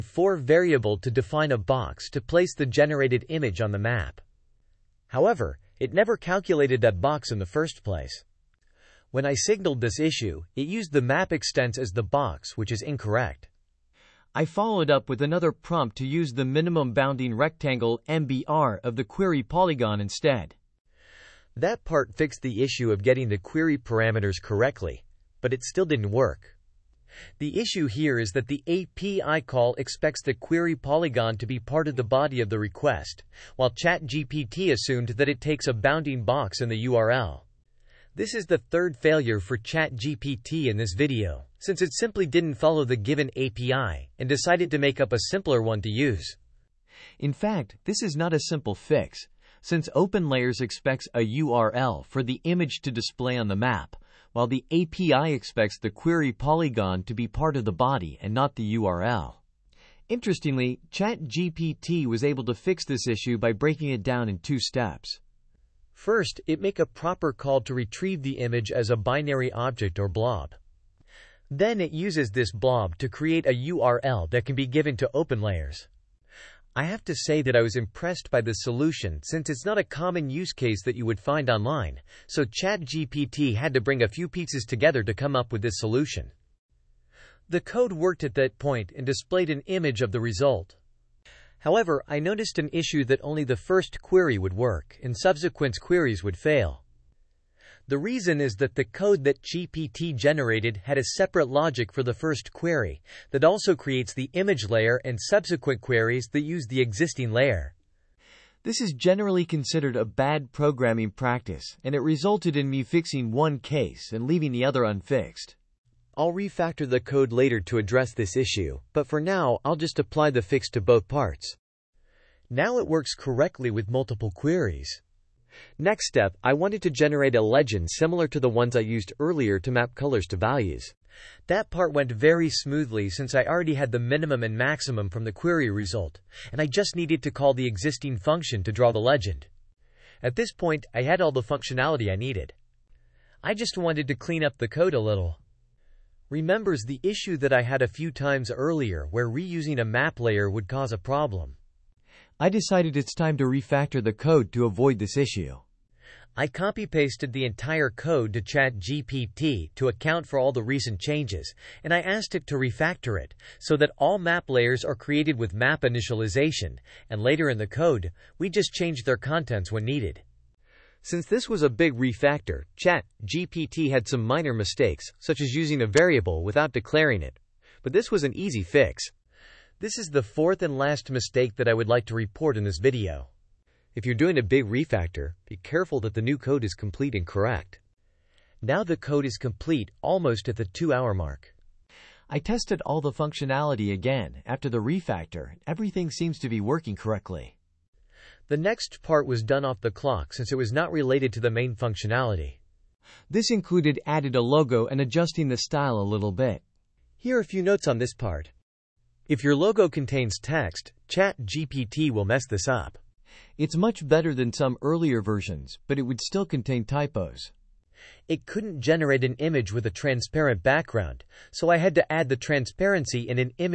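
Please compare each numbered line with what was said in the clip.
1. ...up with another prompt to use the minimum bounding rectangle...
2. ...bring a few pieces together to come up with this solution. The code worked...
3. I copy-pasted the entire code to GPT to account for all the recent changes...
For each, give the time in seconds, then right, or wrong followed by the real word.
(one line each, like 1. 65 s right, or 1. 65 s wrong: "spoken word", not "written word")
1. 14 s right
2. 83 s right
3. 156 s wrong: "ChatGPT", not "GPT".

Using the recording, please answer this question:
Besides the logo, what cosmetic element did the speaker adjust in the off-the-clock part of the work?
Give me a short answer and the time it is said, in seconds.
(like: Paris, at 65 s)
style, at 205 s.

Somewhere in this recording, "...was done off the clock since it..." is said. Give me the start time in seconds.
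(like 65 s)
199 s.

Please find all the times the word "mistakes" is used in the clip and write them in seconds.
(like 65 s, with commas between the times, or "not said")
174 s, 181 s.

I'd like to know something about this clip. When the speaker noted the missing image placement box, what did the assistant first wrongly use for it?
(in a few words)
map extents.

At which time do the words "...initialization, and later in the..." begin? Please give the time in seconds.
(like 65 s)
165 s.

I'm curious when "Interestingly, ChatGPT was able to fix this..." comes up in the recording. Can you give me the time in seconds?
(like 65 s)
60 s.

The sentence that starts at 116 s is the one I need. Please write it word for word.
I'll refactor the code later to address this issue, but for now, I'll just apply the fix to both parts.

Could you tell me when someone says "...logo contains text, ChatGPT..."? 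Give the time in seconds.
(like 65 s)
209 s.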